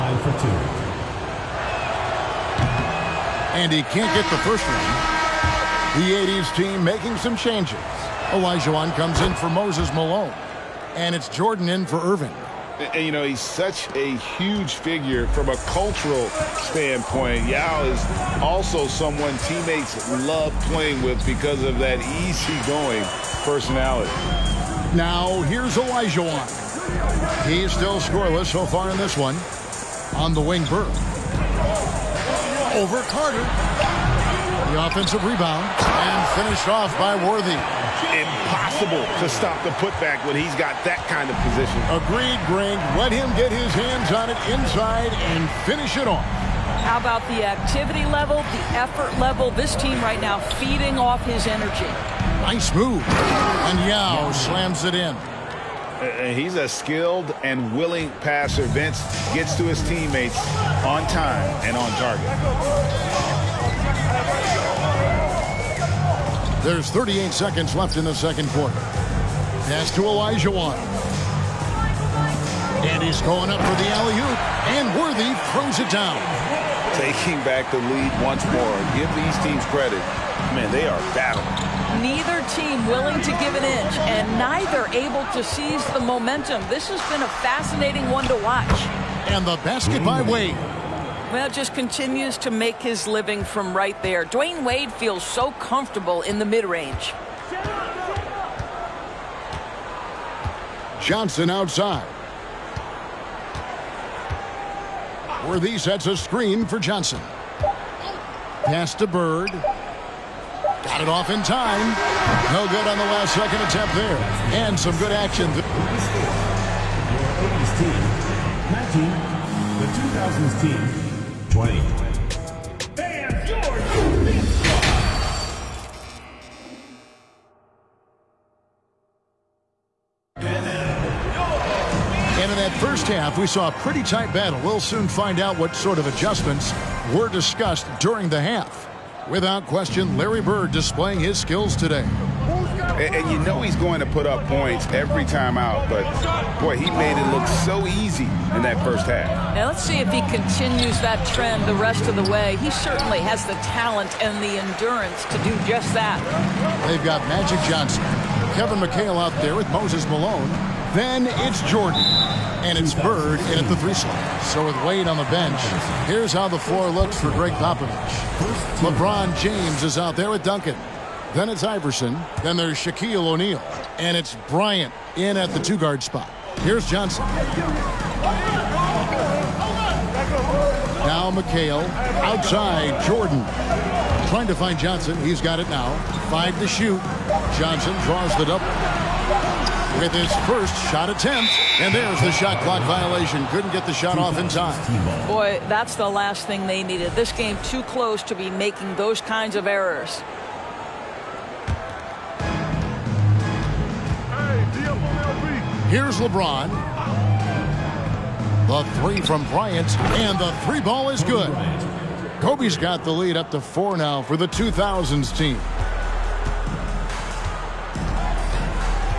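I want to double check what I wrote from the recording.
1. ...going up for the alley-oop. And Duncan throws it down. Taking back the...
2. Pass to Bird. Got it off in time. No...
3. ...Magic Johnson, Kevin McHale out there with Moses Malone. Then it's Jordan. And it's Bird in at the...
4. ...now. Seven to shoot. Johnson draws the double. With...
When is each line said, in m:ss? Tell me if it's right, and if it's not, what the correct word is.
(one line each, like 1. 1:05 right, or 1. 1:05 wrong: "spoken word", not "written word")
1. 1:13 wrong: "Worthy", not "Duncan"
2. 1:48 right
3. 2:37 right
4. 3:05 wrong: "Five", not "Seven".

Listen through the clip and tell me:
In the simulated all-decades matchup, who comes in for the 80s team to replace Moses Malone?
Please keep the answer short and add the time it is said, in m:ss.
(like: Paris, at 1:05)
Elijah, at 0:08.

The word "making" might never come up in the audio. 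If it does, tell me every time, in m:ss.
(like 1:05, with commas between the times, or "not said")
0:06, 3:18.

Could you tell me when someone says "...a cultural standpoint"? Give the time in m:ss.
0:15.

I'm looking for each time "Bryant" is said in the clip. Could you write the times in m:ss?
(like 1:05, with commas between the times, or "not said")
2:54, 3:29.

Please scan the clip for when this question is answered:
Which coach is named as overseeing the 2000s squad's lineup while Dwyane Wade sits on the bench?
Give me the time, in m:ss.
2:47.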